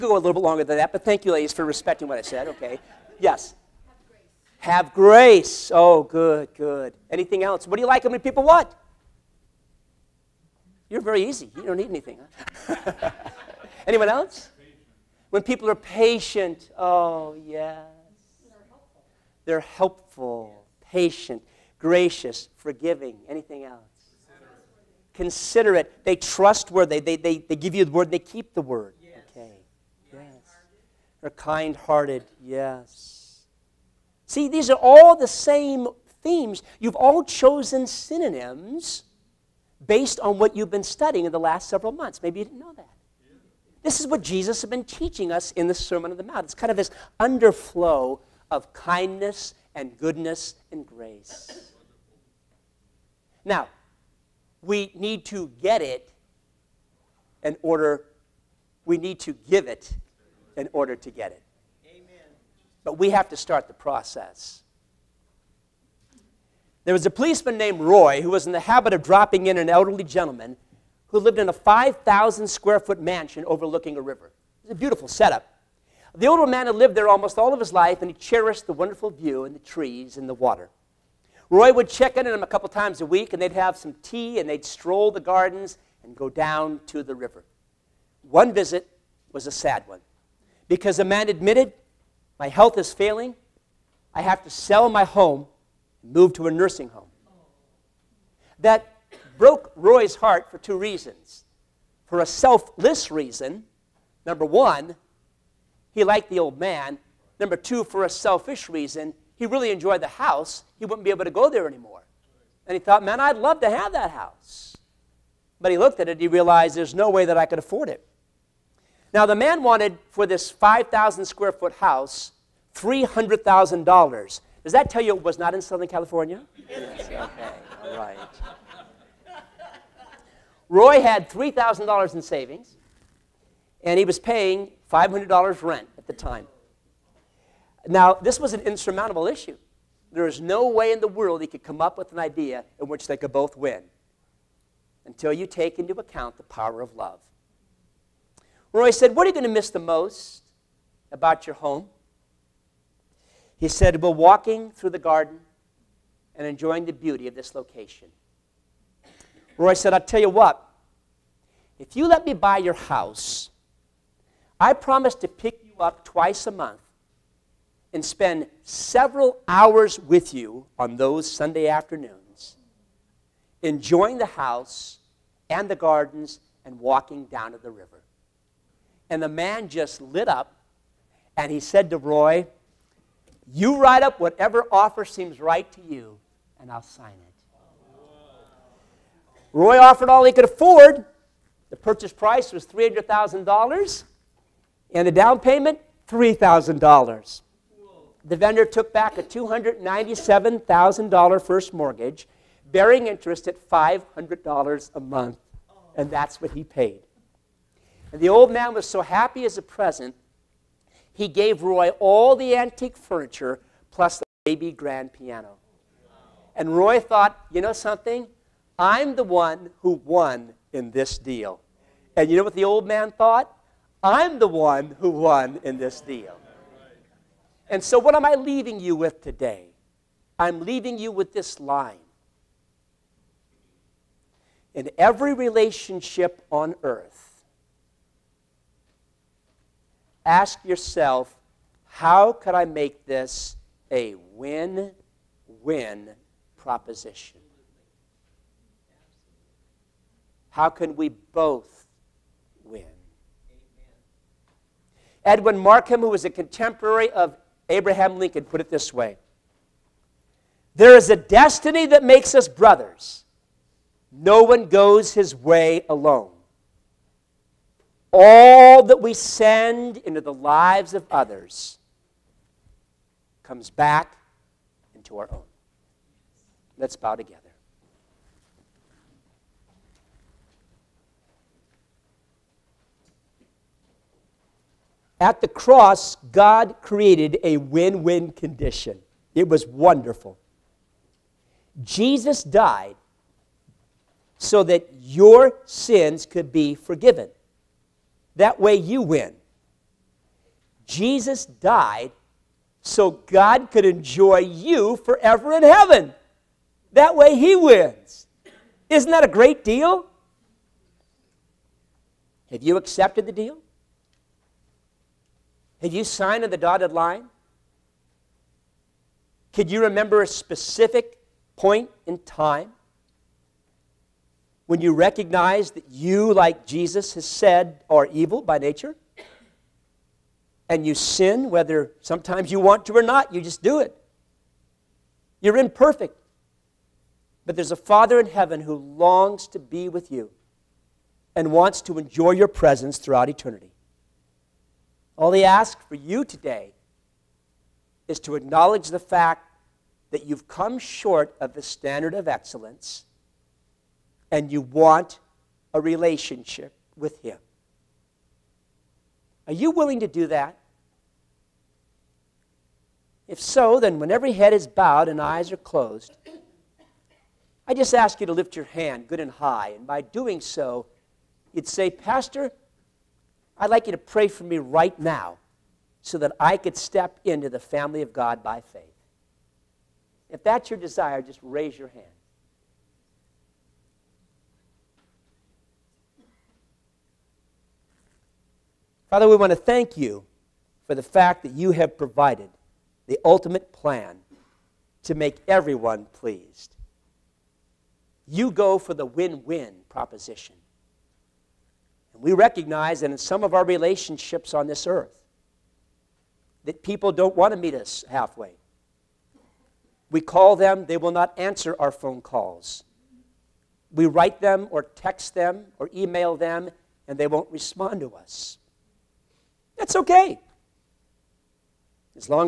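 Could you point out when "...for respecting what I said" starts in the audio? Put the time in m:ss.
0:01.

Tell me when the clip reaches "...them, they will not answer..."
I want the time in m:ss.
6:50.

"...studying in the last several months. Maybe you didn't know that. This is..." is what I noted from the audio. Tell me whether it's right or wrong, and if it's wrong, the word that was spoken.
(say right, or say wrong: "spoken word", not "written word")
right.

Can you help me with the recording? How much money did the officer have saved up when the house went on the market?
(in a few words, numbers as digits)
$3,000.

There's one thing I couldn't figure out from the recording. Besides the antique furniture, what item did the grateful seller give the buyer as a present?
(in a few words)
baby grand piano.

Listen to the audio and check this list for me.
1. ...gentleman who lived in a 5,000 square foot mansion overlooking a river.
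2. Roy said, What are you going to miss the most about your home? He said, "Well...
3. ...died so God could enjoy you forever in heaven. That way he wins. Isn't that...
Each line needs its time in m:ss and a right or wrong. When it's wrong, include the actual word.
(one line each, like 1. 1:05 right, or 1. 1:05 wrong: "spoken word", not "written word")
1. 1:10 right
2. 2:28 right
3. 5:01 right.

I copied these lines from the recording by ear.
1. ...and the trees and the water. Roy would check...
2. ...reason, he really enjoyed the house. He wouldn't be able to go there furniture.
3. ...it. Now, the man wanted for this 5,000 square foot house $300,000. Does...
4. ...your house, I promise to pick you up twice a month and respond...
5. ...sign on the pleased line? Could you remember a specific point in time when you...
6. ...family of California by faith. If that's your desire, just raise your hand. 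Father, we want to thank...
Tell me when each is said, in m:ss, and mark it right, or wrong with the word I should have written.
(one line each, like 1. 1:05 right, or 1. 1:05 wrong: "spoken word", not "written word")
1. 1:19 right
2. 1:48 wrong: "anymore", not "furniture"
3. 1:57 right
4. 2:42 wrong: "spend", not "respond"
5. 5:16 wrong: "dotted", not "pleased"
6. 6:17 wrong: "God", not "California".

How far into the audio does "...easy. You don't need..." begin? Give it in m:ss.
0:11.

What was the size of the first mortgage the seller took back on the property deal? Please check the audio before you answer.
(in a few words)
$297,000.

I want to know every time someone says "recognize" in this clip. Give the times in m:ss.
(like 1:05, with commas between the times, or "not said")
5:24, 6:42.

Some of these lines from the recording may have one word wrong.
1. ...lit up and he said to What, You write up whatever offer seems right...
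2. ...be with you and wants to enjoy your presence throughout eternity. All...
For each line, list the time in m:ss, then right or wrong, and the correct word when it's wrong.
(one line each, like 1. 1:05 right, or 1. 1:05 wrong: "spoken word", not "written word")
1. 2:59 wrong: "Roy", not "What"
2. 5:39 right.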